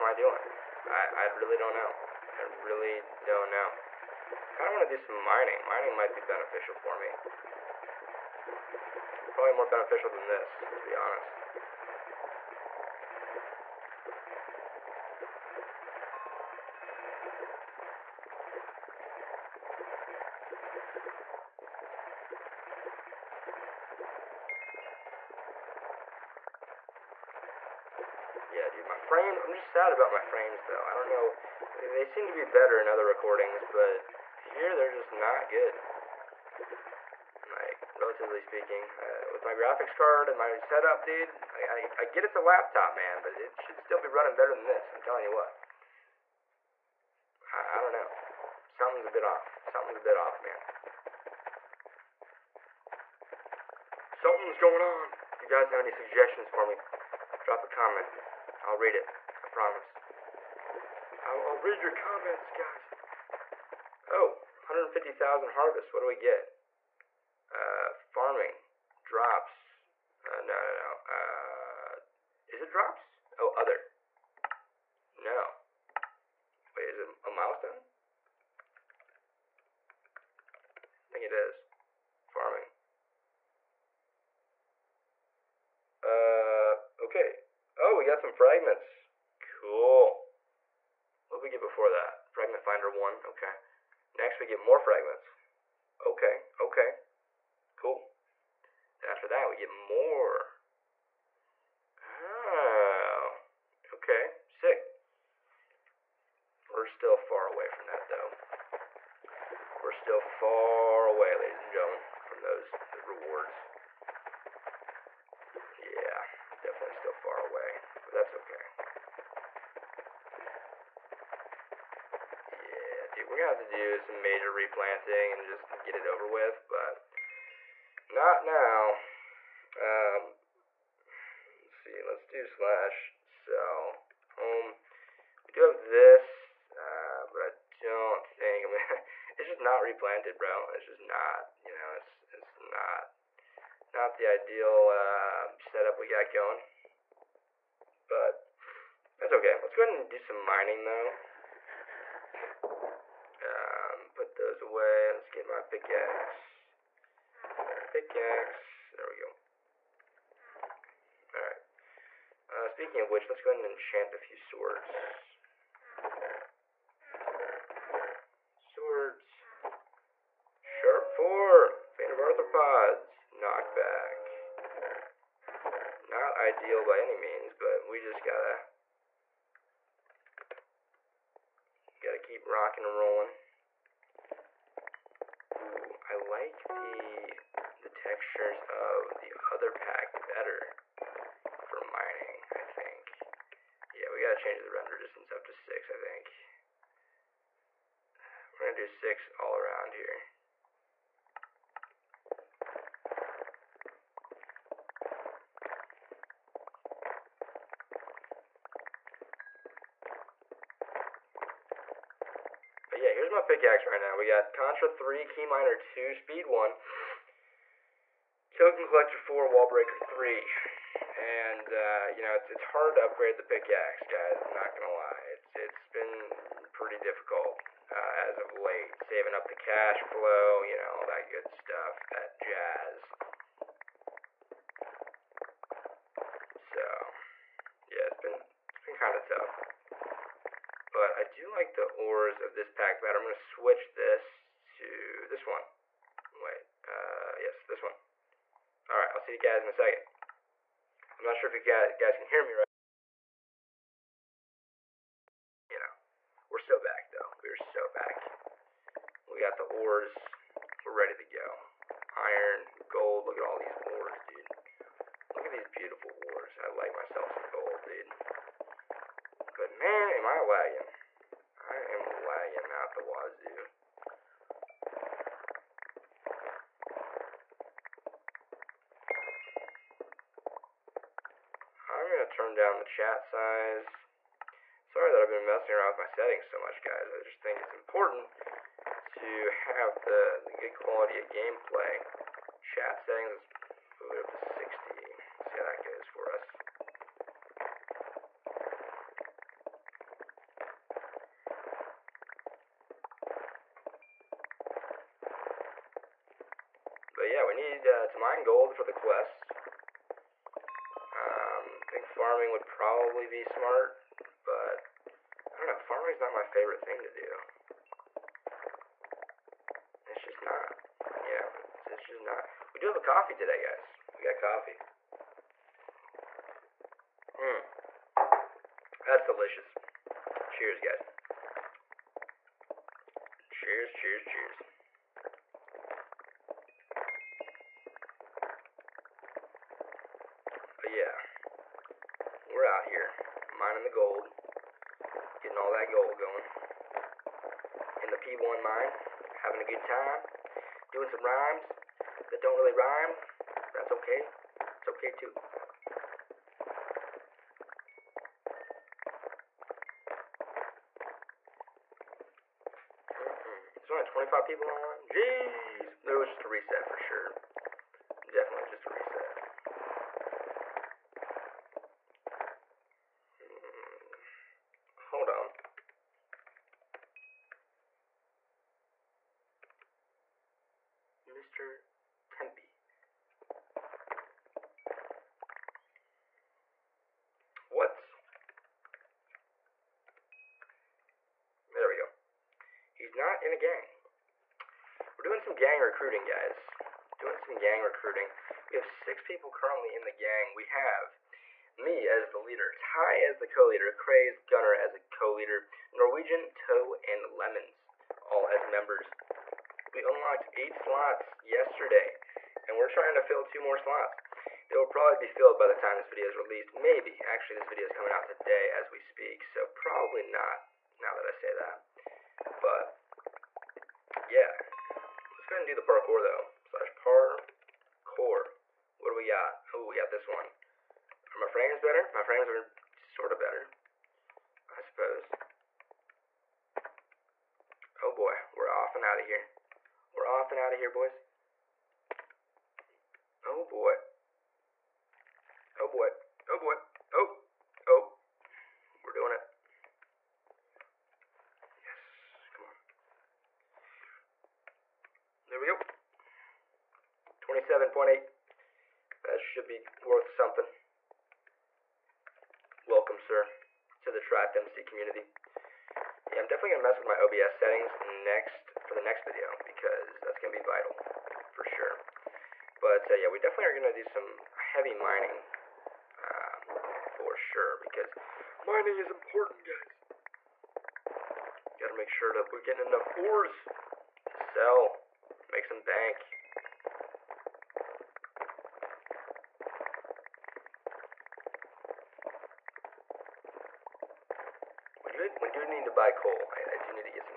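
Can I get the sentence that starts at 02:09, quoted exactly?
Um, let's see, let's do slash sell home.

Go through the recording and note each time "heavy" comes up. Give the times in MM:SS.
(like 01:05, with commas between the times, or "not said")
07:54.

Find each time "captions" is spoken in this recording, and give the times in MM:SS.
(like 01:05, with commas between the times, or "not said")
not said.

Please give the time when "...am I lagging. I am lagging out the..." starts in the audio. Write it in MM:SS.
04:30.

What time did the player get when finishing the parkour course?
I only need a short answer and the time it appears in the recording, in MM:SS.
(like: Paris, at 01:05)
27.8, at 07:37.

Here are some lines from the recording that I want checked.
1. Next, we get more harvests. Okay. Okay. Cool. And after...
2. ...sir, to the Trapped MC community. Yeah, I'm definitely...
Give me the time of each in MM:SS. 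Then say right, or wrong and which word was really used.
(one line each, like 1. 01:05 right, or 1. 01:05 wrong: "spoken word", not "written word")
1. 01:34 wrong: "fragments", not "harvests"
2. 07:43 right.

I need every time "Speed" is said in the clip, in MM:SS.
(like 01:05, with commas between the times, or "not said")
03:36.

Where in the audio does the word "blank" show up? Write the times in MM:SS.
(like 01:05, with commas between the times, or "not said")
not said.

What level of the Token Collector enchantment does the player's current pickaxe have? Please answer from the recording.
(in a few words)
4.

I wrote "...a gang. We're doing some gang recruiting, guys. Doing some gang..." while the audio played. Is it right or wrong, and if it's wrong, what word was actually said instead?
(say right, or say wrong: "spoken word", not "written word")
right.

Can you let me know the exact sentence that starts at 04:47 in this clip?
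I just think it's important to have the, the good quality of gameplay.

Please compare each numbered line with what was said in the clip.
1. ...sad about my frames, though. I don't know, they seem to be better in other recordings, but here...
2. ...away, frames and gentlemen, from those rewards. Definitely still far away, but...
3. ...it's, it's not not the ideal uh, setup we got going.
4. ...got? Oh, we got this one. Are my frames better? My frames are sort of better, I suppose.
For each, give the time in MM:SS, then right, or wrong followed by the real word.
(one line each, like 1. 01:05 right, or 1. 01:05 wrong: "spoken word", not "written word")
1. 00:29 right
2. 01:51 wrong: "ladies", not "frames"
3. 02:21 right
4. 07:09 right.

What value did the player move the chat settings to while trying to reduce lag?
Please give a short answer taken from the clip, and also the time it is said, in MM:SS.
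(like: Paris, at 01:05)
60, at 04:54.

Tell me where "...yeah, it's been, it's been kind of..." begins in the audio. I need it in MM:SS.
03:57.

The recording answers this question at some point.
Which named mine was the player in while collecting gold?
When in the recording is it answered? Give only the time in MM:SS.
05:48.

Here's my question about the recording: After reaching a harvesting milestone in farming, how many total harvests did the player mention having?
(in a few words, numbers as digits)
150,000.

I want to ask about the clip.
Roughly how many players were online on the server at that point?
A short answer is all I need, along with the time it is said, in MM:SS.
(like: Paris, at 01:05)
25, at 06:04.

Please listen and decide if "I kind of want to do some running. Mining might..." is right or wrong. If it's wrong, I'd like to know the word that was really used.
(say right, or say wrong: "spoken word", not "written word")
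wrong: "mining", not "running".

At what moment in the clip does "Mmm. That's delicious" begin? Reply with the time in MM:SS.
05:27.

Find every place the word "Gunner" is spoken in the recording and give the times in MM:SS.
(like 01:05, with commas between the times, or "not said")
06:44.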